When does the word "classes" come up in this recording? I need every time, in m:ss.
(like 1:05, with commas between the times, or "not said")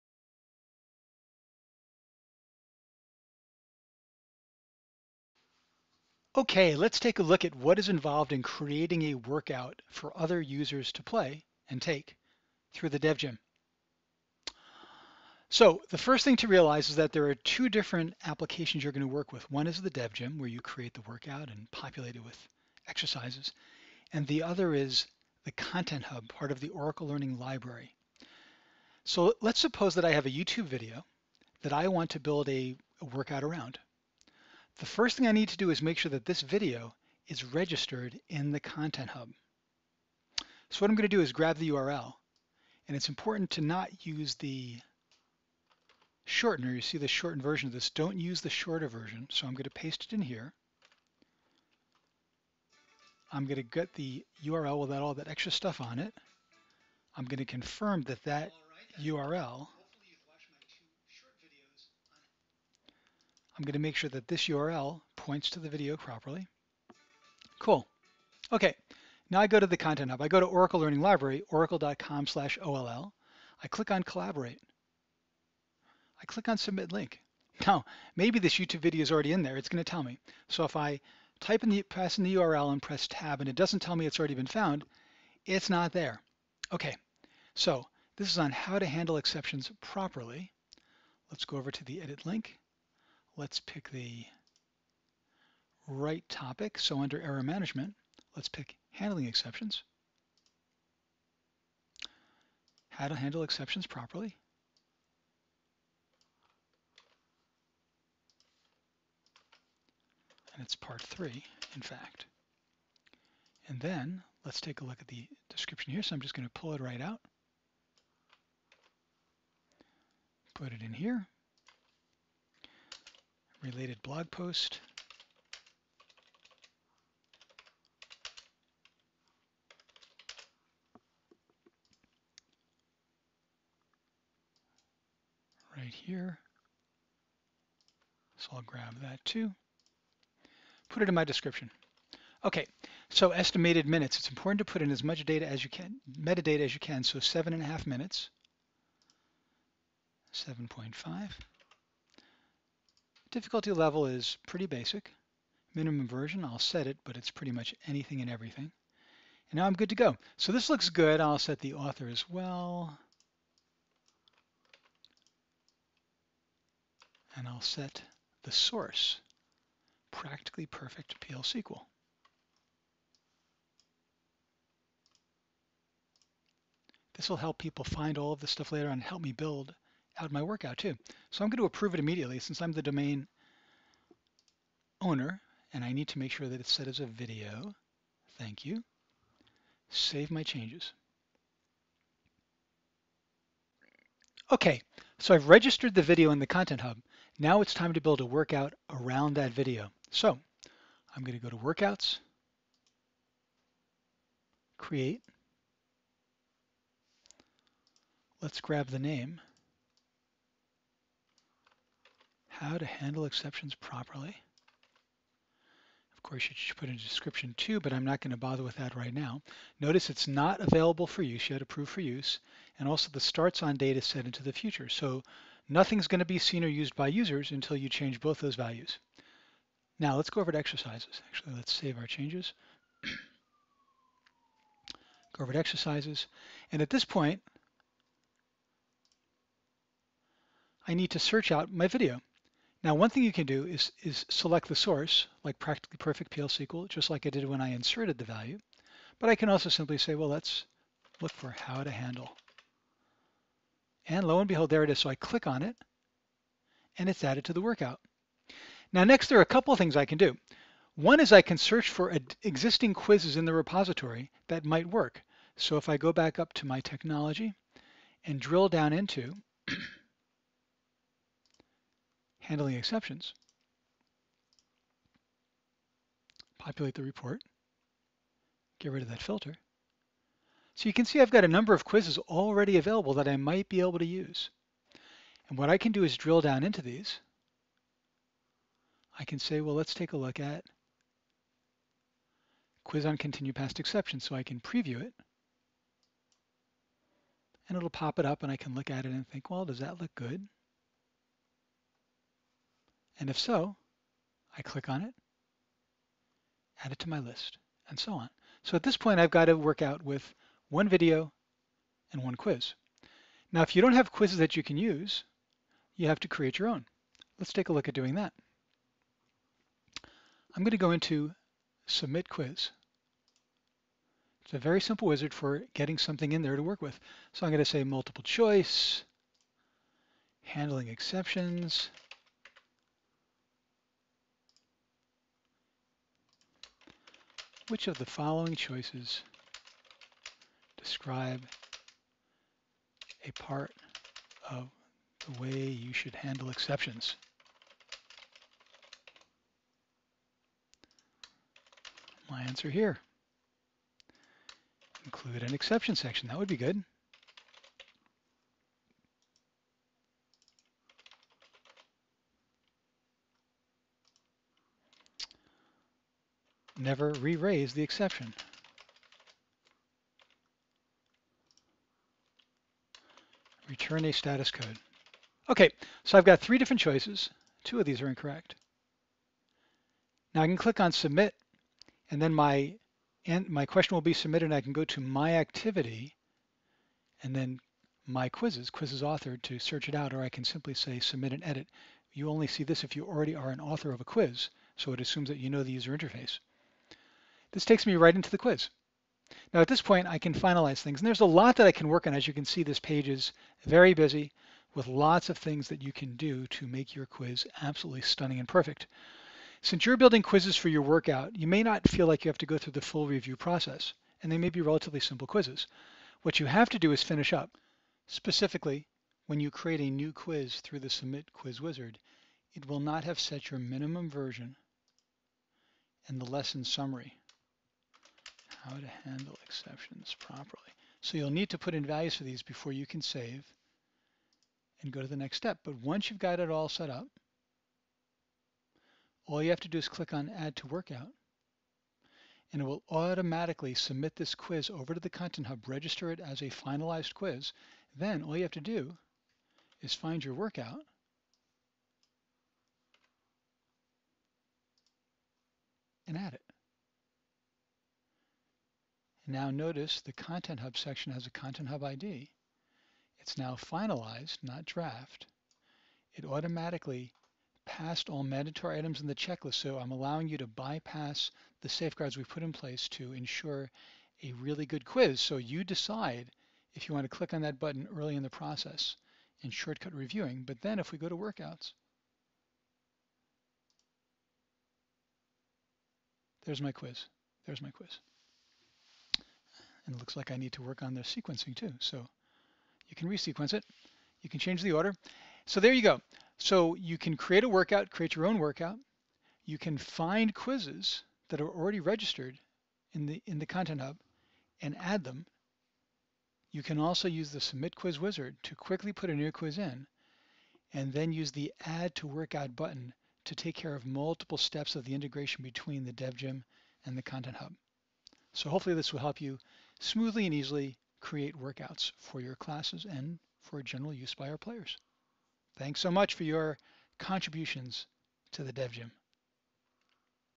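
8:42.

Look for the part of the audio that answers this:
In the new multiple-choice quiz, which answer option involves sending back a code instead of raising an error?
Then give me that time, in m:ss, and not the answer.
6:13.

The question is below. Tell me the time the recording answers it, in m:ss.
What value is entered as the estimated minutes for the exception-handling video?
2:30.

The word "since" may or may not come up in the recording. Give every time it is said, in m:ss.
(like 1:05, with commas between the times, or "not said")
3:02, 6:49.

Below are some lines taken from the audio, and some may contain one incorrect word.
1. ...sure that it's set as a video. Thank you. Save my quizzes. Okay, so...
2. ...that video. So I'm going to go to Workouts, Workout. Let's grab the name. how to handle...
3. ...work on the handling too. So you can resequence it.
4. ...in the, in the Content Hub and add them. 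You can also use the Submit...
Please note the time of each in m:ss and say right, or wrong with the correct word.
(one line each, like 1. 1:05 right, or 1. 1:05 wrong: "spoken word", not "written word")
1. 3:06 wrong: "changes", not "quizzes"
2. 3:19 wrong: "Create", not "Workout"
3. 8:10 wrong: "sequencing", not "handling"
4. 8:22 right.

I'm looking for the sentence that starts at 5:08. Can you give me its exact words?
So at this point, I've got to work out with one video and one quiz.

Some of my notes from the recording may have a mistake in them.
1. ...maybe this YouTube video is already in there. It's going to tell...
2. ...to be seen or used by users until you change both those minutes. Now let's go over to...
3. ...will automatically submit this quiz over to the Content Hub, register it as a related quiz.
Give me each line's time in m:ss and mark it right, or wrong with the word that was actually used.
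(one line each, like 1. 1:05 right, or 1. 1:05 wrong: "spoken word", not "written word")
1. 1:18 right
2. 3:46 wrong: "values", not "minutes"
3. 7:22 wrong: "finalized", not "related".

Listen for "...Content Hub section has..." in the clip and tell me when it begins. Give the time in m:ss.
7:40.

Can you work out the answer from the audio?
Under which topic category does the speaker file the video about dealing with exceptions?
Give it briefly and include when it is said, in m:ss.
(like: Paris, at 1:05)
Error management, at 1:37.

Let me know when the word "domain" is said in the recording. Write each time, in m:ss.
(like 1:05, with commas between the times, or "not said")
3:02.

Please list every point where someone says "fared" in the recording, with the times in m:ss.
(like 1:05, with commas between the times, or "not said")
not said.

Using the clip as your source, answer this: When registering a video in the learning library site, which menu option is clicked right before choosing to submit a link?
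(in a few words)
Collaborate.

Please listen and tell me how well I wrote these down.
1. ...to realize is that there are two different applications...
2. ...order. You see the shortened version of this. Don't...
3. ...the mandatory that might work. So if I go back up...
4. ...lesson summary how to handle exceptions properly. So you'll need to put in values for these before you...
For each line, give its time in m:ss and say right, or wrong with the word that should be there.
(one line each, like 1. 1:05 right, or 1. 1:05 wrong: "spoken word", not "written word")
1. 0:16 right
2. 0:46 wrong: "shortener", not "order"
3. 4:23 wrong: "repository", not "mandatory"
4. 7:06 right.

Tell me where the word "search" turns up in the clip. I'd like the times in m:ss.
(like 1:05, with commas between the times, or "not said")
4:01, 4:21, 6:29.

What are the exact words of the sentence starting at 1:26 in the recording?
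Okay, so this is on how to handle exceptions properly.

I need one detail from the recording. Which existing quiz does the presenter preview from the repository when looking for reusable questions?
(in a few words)
Continue past exceptions.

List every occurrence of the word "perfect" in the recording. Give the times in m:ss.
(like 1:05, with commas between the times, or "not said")
2:50, 4:05, 6:48.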